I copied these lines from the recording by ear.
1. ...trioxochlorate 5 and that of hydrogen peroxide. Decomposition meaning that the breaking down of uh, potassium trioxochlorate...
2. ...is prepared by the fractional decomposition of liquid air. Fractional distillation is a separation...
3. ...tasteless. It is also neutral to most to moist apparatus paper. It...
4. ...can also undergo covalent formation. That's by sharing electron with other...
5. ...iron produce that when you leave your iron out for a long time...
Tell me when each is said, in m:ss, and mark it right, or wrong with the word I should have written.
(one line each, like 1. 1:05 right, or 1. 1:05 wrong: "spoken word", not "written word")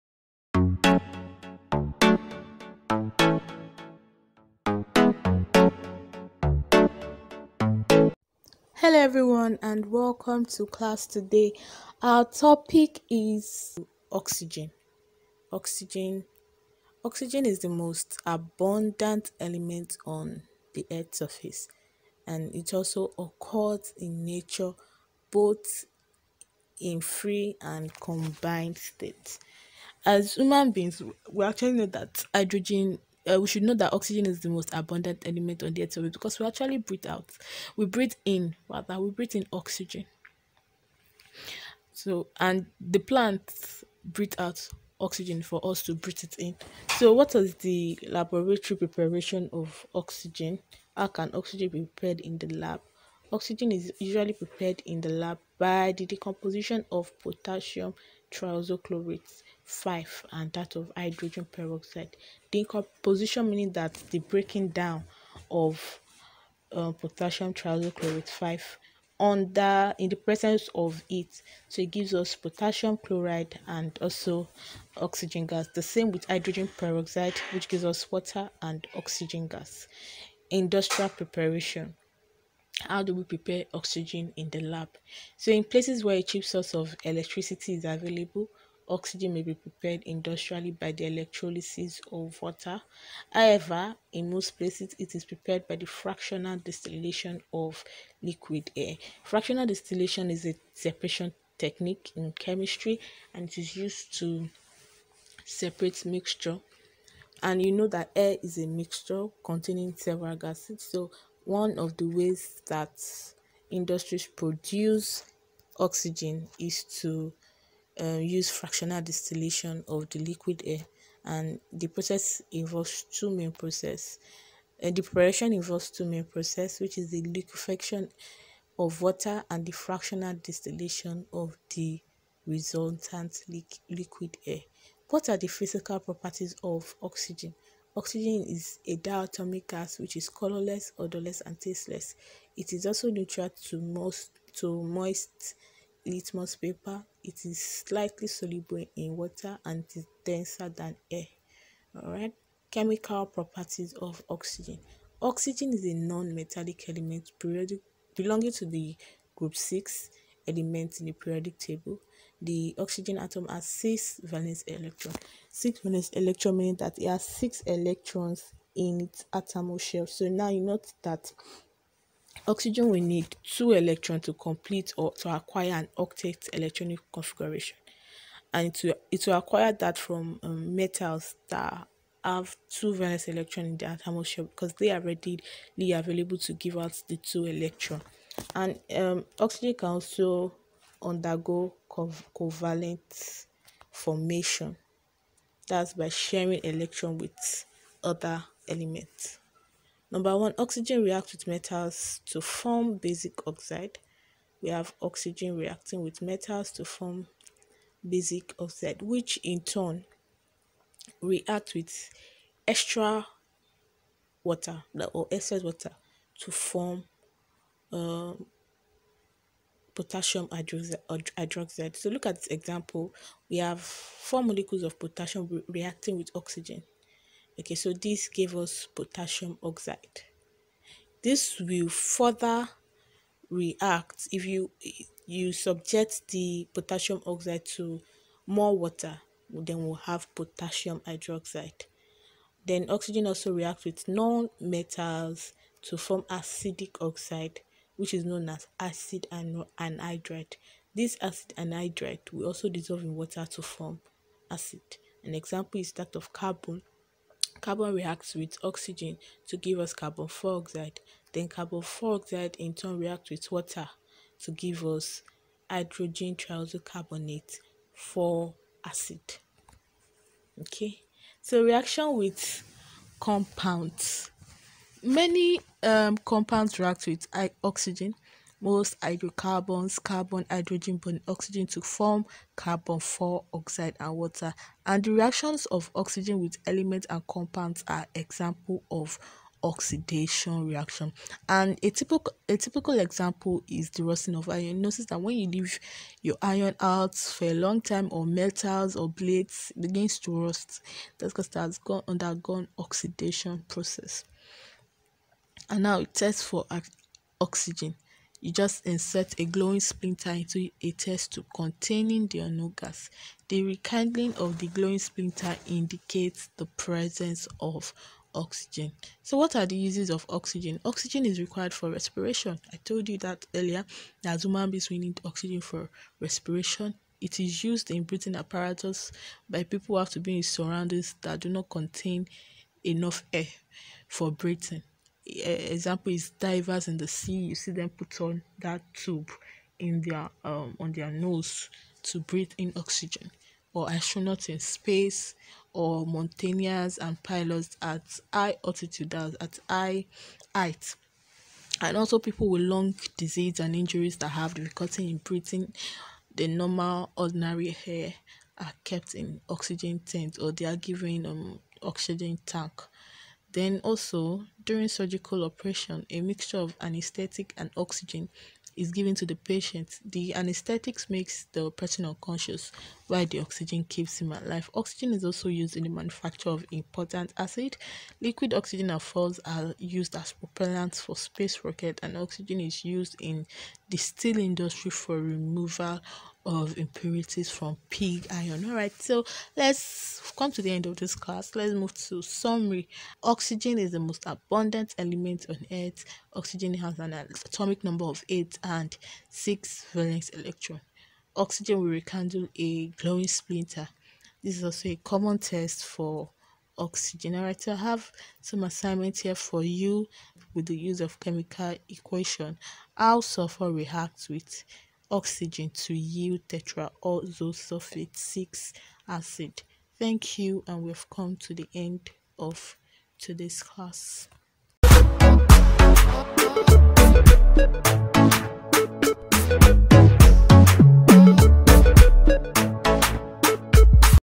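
1. 0:58 right
2. 1:35 wrong: "distillation", not "decomposition"
3. 2:21 wrong: "litmus", not "apparatus"
4. 3:09 right
5. 4:54 wrong: "notice", not "produce".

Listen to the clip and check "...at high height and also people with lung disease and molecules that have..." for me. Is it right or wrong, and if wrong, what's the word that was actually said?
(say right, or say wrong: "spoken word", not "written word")
wrong: "injuries", not "molecules".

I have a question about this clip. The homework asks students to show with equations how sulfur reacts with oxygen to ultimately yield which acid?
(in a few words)
Tetraoxosulfate 6 acid.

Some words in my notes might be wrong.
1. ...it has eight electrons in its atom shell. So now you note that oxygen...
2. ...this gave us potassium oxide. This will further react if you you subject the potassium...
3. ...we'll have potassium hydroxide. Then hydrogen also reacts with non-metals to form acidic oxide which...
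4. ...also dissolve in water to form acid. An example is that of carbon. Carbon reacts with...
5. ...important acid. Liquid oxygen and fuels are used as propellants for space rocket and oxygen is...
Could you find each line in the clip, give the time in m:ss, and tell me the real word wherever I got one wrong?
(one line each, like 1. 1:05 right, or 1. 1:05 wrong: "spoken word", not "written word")
1. 2:46 wrong: "six", not "eight"
2. 3:47 right
3. 3:59 wrong: "oxygen", not "hydrogen"
4. 4:12 right
5. 6:16 right.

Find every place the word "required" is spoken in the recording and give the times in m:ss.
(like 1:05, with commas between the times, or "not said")
5:21.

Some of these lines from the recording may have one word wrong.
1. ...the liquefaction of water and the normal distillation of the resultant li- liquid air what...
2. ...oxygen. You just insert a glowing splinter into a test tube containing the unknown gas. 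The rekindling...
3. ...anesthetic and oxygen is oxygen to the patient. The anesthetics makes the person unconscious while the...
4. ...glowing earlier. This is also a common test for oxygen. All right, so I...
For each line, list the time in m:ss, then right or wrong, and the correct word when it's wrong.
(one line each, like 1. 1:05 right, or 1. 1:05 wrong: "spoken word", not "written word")
1. 2:07 wrong: "fractional", not "normal"
2. 5:07 right
3. 6:06 wrong: "given", not "oxygen"
4. 6:42 wrong: "splinter", not "earlier".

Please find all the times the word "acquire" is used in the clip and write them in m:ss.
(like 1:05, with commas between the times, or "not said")
2:55, 2:59.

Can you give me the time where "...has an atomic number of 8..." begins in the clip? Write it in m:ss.
6:36.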